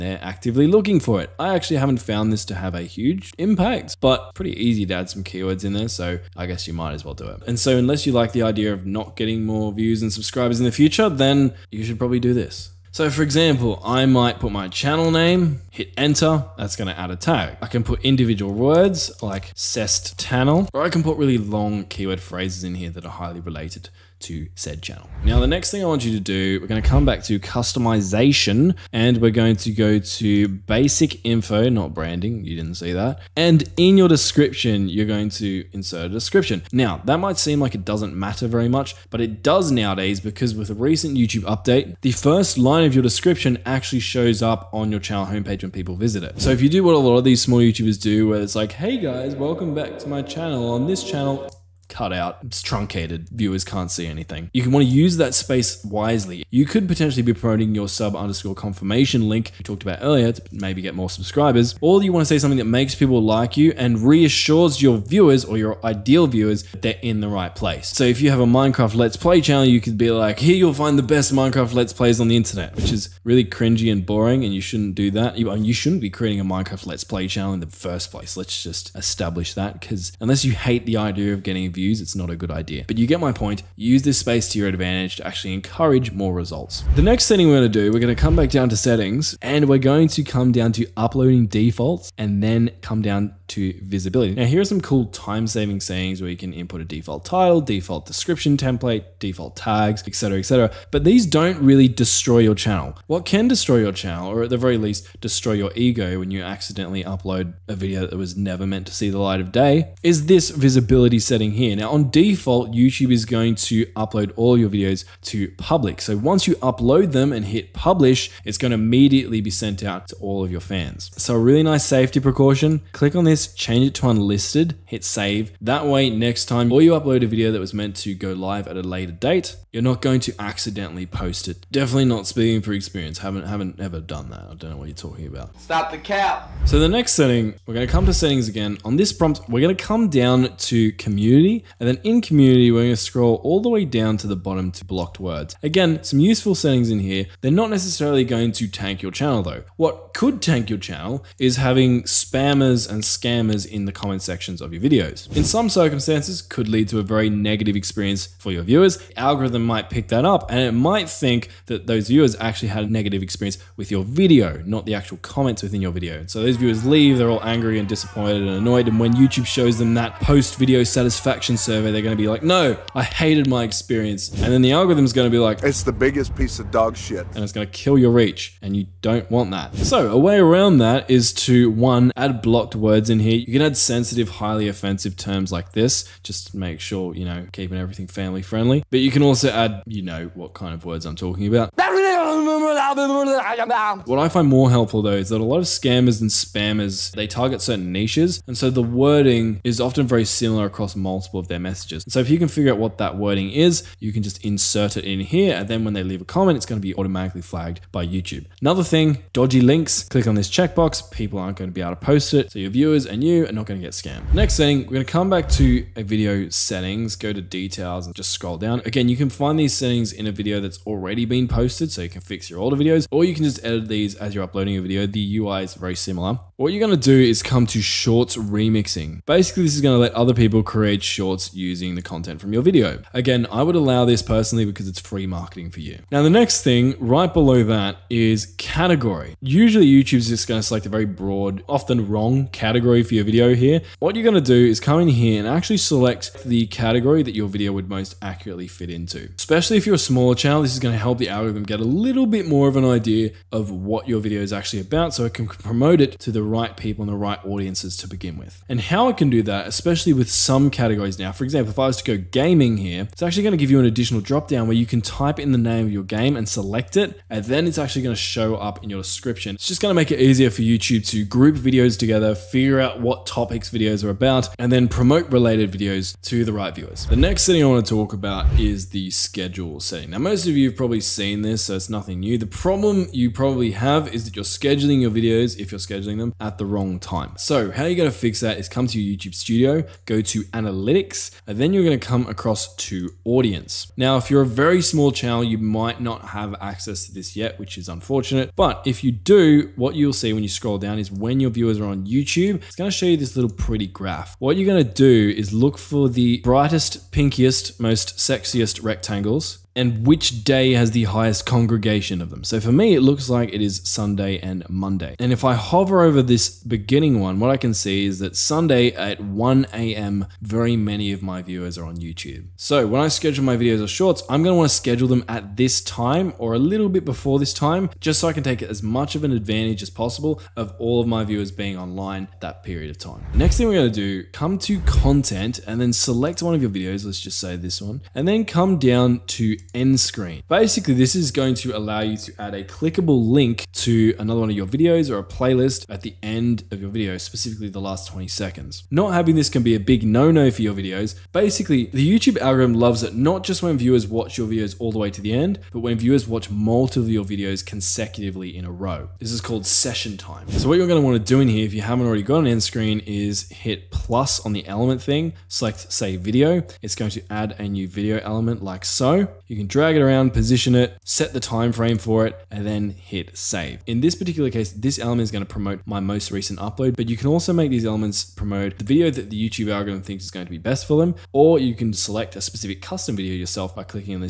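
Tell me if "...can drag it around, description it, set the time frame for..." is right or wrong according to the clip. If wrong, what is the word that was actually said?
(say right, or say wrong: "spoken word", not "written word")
wrong: "position", not "description".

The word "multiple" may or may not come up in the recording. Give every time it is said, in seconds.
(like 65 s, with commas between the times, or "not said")
200 s, 356 s.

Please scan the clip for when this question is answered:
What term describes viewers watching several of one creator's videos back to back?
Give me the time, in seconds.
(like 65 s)
359 s.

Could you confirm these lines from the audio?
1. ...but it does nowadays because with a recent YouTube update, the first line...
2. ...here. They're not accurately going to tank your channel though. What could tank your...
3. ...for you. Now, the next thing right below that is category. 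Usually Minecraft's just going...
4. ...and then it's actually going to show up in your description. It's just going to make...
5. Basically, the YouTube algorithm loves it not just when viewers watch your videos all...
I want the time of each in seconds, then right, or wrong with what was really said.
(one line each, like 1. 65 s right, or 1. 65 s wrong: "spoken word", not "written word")
1. 39 s right
2. 147 s wrong: "necessarily", not "accurately"
3. 235 s wrong: "YouTube", not "Minecraft"
4. 267 s right
5. 351 s right.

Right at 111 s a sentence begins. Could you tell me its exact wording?
Now on default, YouTube is going to upload all your videos to public.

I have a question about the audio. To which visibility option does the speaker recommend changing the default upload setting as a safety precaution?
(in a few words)
Unlisted.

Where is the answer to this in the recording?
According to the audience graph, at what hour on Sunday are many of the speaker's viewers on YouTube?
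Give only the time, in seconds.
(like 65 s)
319 s.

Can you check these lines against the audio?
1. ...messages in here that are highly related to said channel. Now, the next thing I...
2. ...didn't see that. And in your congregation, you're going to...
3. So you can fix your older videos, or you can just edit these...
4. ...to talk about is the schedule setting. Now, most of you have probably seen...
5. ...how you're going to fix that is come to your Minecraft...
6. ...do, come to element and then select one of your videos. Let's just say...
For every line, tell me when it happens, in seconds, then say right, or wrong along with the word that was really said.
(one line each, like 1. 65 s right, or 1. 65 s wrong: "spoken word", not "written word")
1. 22 s wrong: "phrases", not "messages"
2. 32 s wrong: "description", not "congregation"
3. 221 s right
4. 277 s right
5. 287 s wrong: "YouTube", not "Minecraft"
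6. 334 s wrong: "content", not "element".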